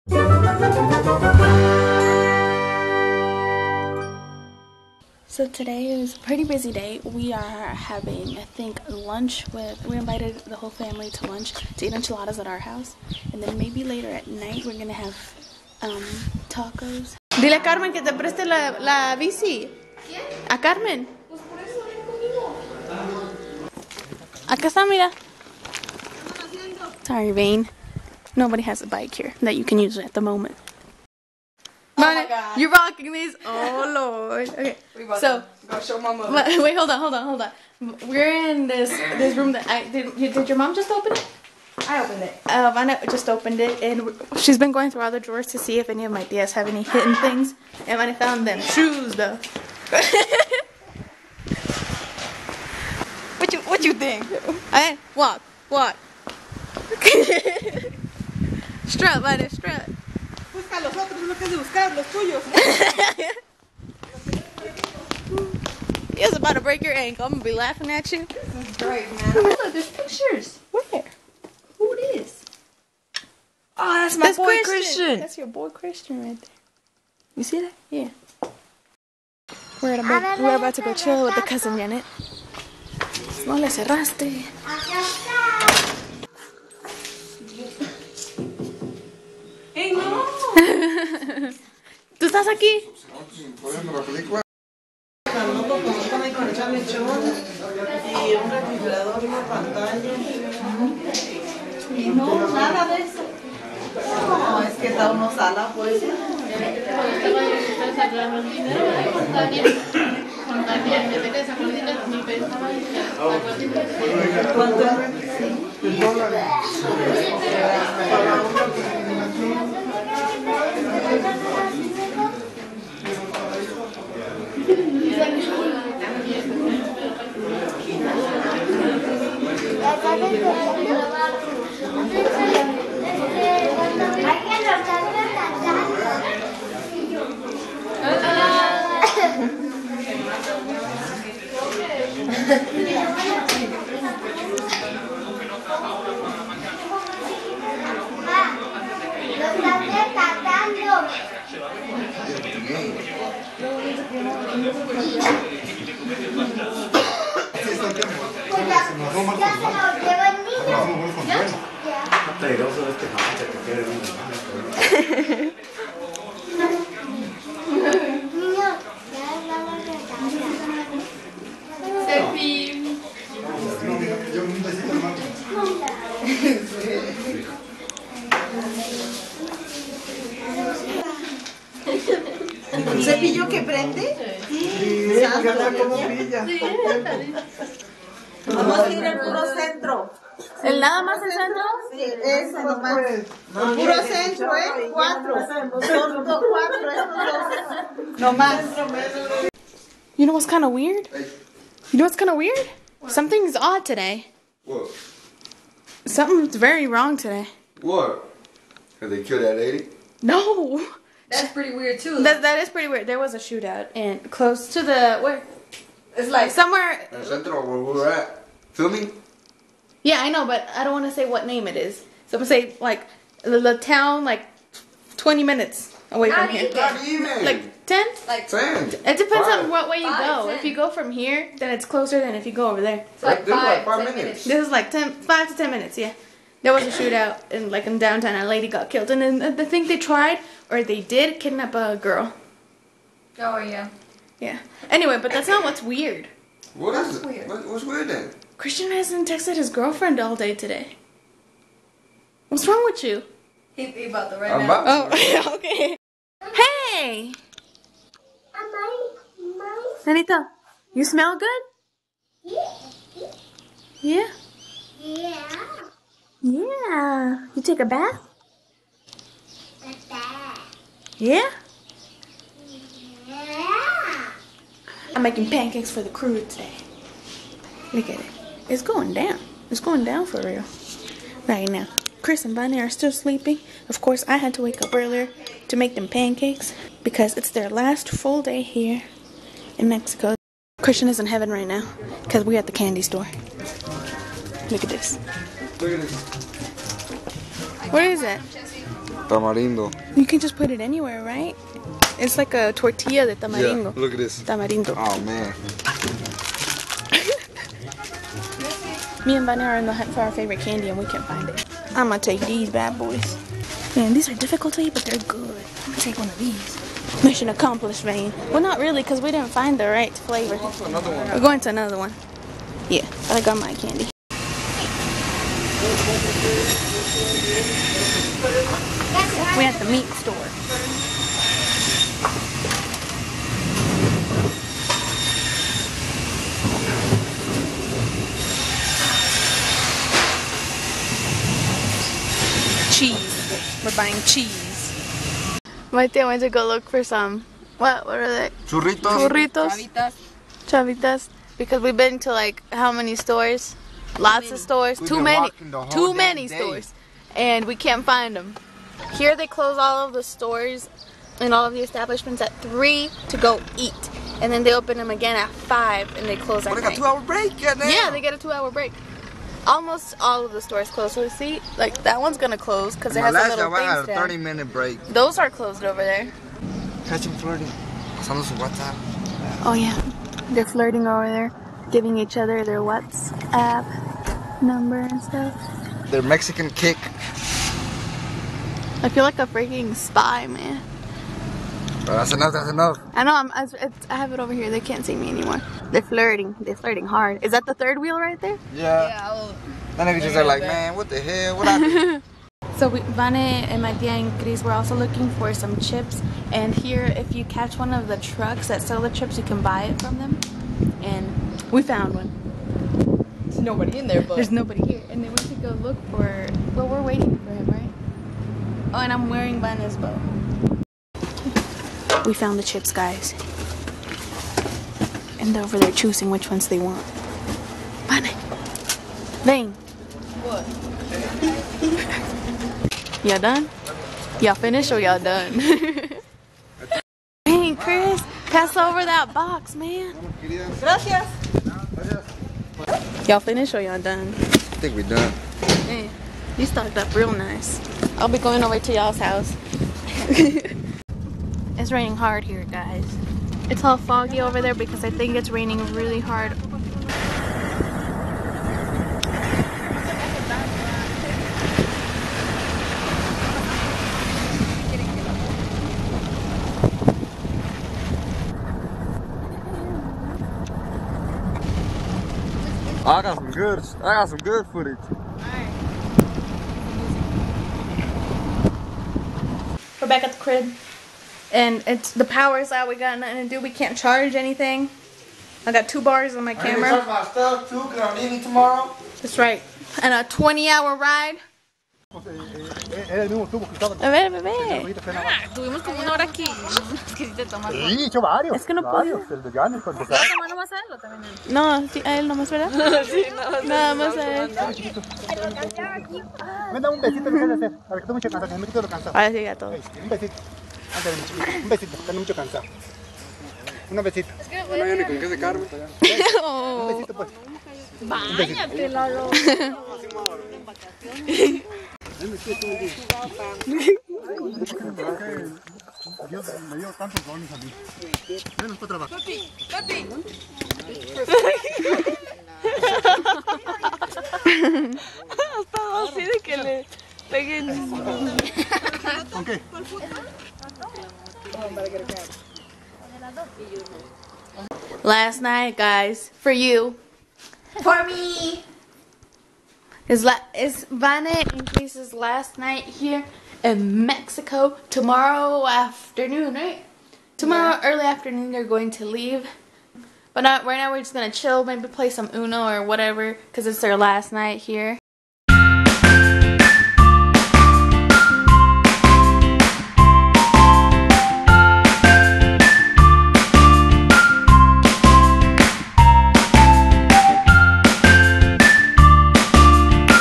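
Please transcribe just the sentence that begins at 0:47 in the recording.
And when I found them shoes, though.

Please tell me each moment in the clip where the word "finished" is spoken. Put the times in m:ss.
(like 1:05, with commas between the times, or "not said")
7:14, 7:23.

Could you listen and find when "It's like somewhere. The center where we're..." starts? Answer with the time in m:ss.
3:36.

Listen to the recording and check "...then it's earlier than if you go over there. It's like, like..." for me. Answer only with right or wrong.
wrong.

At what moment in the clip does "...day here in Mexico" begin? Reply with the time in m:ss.
4:48.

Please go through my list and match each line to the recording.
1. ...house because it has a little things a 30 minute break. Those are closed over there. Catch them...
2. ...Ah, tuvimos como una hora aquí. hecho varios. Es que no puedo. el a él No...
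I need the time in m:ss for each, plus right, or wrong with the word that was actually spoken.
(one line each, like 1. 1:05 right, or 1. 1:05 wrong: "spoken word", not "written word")
1. 6:12 wrong: "close", not "house"
2. 8:15 right.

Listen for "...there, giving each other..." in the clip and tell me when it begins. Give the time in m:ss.
6:21.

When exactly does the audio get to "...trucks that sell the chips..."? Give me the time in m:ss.
6:48.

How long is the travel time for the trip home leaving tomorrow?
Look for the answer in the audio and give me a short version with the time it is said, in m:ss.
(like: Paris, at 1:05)
20 hours, at 8:10.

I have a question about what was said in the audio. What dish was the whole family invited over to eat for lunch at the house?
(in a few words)
Enchiladas.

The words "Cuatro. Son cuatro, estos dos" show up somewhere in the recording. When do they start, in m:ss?
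3:14.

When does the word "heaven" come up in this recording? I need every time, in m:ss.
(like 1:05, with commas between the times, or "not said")
4:51.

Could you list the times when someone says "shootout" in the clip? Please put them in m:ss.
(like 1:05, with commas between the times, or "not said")
3:33, 3:56.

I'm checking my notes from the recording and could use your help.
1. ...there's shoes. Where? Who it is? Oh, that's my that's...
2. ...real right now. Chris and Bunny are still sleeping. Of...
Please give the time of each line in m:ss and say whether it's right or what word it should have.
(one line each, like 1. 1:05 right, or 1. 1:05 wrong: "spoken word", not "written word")
1. 1:09 wrong: "pictures", not "shoes"
2. 4:40 right.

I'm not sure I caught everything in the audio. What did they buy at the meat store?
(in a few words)
Cheese.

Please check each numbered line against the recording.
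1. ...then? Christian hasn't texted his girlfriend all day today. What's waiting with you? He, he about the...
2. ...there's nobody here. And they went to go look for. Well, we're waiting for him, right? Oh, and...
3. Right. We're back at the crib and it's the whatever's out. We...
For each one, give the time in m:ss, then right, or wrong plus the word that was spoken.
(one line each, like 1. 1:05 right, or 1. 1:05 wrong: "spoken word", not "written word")
1. 4:08 wrong: "wrong", not "waiting"
2. 6:54 right
3. 7:55 wrong: "power", not "whatever".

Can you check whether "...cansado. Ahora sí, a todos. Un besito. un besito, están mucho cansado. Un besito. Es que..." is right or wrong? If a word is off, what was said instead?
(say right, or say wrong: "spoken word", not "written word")
right.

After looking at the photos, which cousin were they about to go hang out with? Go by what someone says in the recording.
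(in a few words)
Janet.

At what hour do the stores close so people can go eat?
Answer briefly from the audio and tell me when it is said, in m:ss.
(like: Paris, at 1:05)
3, at 6:02.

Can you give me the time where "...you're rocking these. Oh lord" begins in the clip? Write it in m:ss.
0:32.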